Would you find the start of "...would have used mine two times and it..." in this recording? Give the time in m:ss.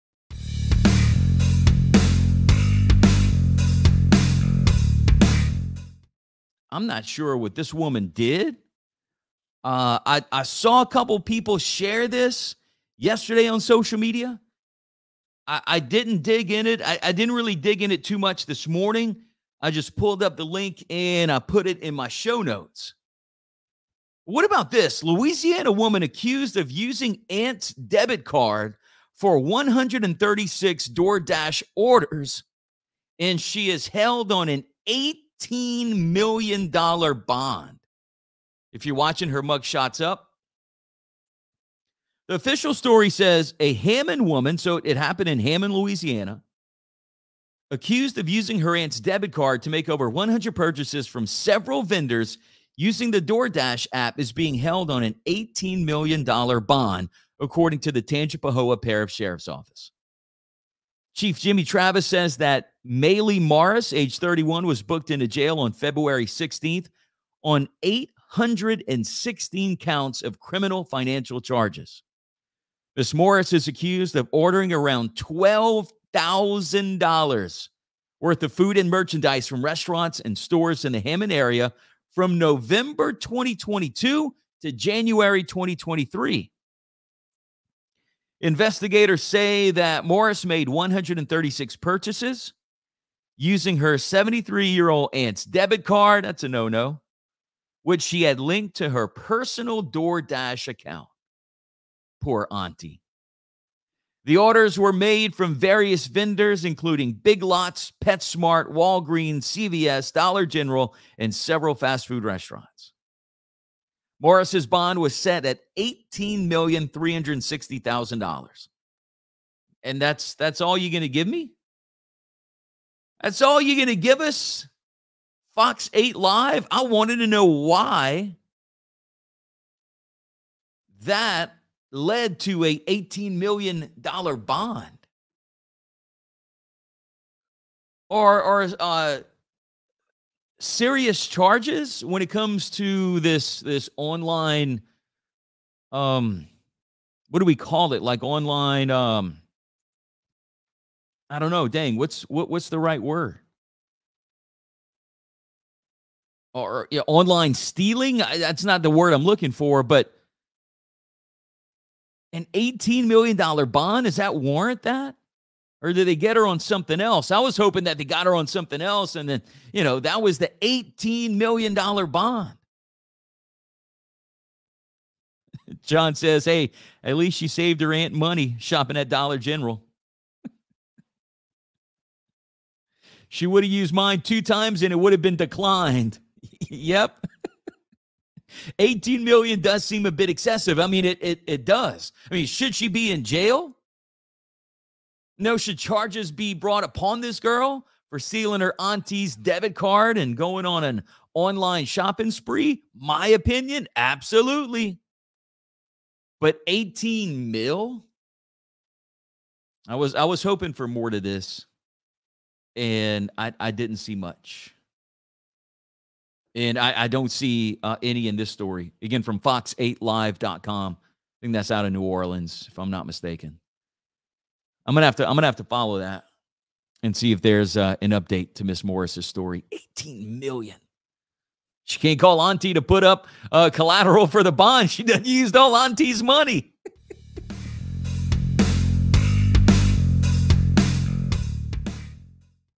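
3:03.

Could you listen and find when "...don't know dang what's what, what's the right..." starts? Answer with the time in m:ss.
2:31.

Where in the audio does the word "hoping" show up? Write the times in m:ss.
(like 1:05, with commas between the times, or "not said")
2:47, 3:30.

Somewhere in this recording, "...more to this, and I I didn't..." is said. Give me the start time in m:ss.
3:30.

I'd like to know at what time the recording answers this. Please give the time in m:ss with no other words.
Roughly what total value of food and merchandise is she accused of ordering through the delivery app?
1:15.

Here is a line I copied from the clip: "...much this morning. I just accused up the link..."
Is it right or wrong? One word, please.
wrong.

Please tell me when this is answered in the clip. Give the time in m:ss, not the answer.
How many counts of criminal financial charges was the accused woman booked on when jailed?
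1:07.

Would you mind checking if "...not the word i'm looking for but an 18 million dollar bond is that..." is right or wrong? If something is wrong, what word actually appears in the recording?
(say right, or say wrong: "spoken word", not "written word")
right.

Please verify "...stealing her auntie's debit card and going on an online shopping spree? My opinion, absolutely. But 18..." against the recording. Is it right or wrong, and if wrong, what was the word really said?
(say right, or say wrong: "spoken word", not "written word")
right.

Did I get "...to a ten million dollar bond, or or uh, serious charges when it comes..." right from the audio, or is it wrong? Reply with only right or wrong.
wrong.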